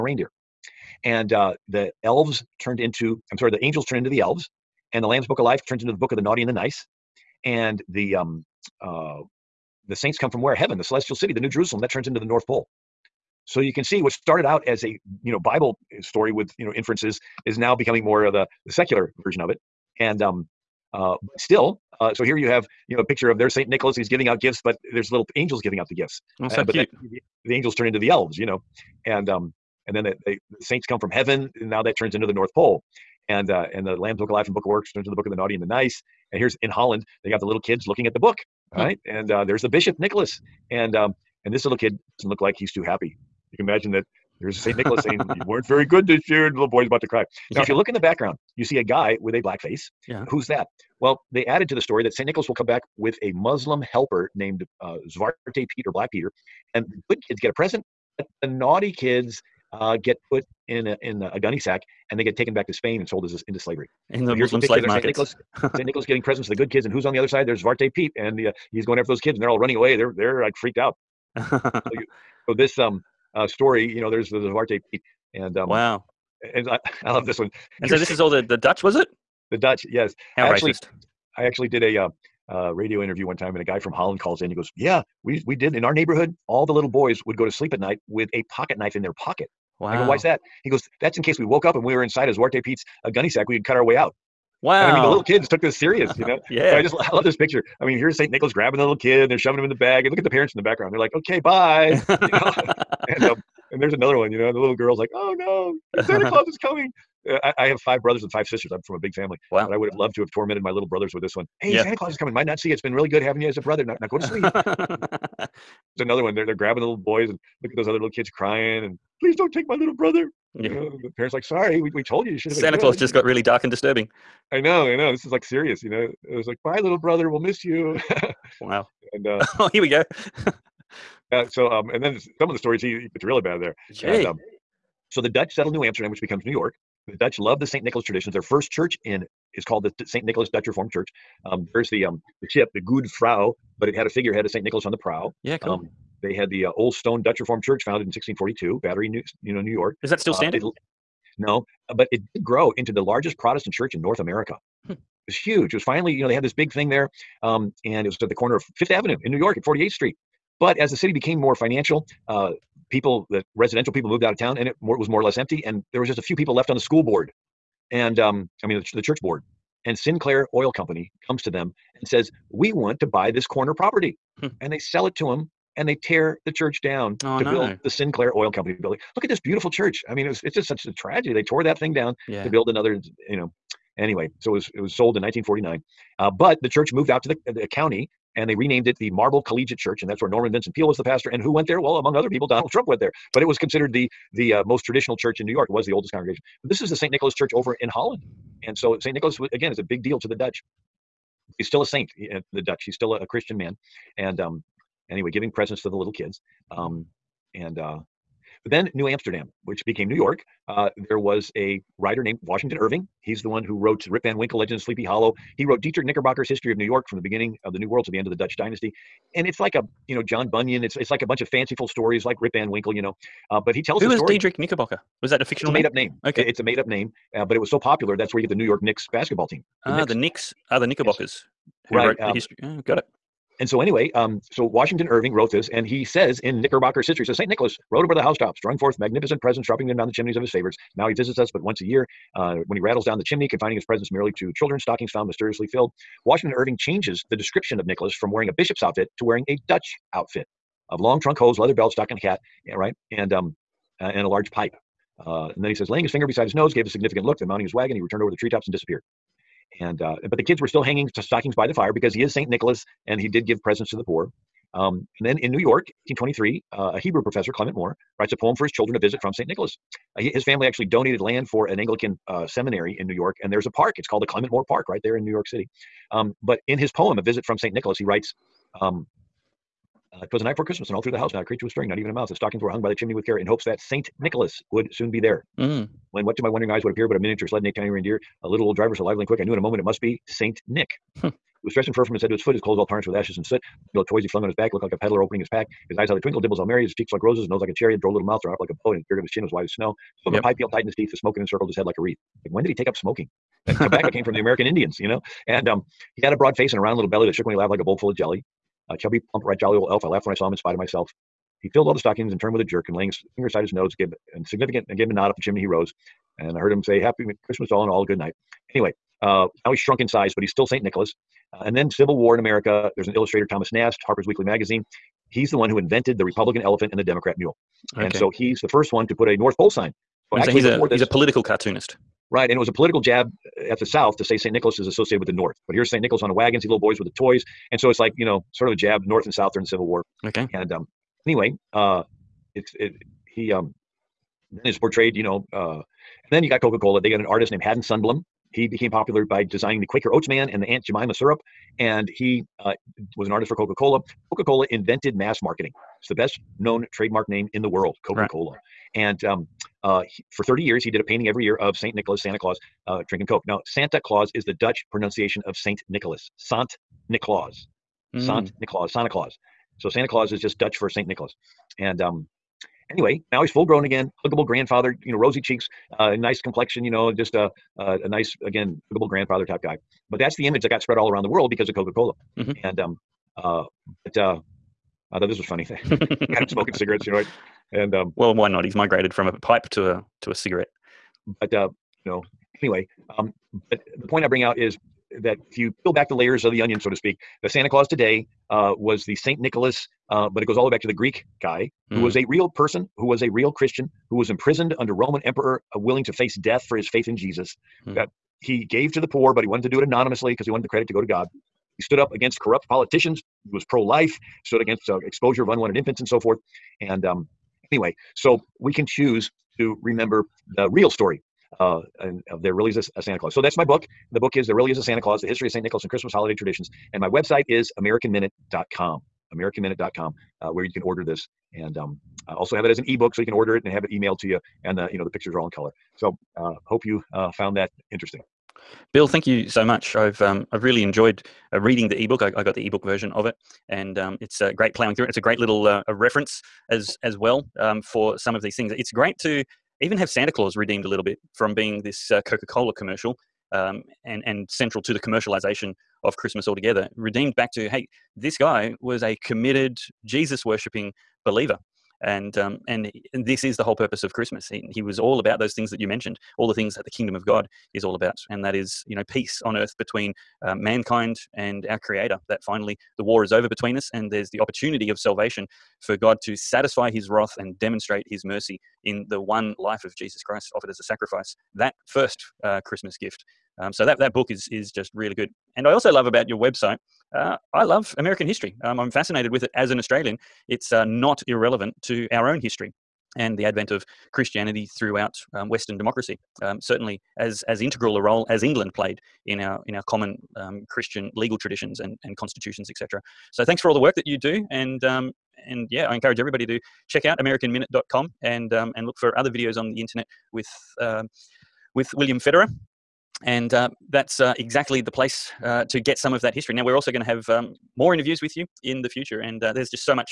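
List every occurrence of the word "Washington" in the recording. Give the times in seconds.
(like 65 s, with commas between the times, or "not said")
212 s, 234 s, 246 s.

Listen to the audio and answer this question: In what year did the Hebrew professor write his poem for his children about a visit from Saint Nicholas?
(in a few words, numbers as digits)
1823.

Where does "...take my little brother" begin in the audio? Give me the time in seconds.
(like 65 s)
119 s.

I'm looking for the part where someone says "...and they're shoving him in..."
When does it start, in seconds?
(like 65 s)
99 s.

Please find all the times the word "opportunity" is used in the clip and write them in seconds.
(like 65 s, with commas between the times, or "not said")
474 s.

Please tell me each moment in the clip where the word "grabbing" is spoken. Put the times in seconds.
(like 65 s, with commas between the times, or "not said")
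98 s, 116 s.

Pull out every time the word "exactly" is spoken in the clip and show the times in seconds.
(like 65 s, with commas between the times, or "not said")
514 s.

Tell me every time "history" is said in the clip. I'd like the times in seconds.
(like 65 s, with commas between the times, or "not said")
216 s, 232 s, 237 s, 425 s, 488 s, 492 s, 516 s.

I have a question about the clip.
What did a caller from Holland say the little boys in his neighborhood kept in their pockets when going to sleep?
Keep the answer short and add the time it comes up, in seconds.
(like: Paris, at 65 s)
A pocket knife, at 88 s.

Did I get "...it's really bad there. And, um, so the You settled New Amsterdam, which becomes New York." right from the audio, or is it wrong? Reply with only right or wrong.
wrong.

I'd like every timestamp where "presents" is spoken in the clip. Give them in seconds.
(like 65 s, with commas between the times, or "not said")
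57 s, 66 s, 205 s, 239 s, 243 s, 263 s.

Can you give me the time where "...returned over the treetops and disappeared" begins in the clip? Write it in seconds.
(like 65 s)
258 s.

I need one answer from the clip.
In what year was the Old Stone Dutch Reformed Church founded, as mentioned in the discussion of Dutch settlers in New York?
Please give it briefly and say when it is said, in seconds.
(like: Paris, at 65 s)
1642, at 148 s.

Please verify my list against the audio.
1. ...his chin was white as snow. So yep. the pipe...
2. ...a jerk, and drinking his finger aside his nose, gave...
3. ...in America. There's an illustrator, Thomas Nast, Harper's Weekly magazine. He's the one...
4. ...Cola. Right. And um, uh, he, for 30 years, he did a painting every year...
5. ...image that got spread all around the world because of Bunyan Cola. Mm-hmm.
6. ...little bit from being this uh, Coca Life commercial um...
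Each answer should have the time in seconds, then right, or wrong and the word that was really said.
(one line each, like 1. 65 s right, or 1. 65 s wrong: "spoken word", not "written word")
1. 299 s right
2. 312 s wrong: "laying", not "drinking"
3. 322 s right
4. 358 s right
5. 380 s wrong: "Coca", not "Bunyan"
6. 450 s wrong: "Cola", not "Life".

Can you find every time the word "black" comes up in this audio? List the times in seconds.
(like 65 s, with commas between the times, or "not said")
49 s, 55 s.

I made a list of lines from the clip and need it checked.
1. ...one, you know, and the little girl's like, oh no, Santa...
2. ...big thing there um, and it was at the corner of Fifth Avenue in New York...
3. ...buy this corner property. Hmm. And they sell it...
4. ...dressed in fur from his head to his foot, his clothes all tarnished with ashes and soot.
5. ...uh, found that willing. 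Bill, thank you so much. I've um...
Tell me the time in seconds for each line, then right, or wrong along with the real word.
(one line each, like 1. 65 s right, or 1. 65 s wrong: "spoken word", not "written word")
1. 104 s right
2. 156 s right
3. 173 s right
4. 291 s right
5. 437 s wrong: "interesting", not "willing".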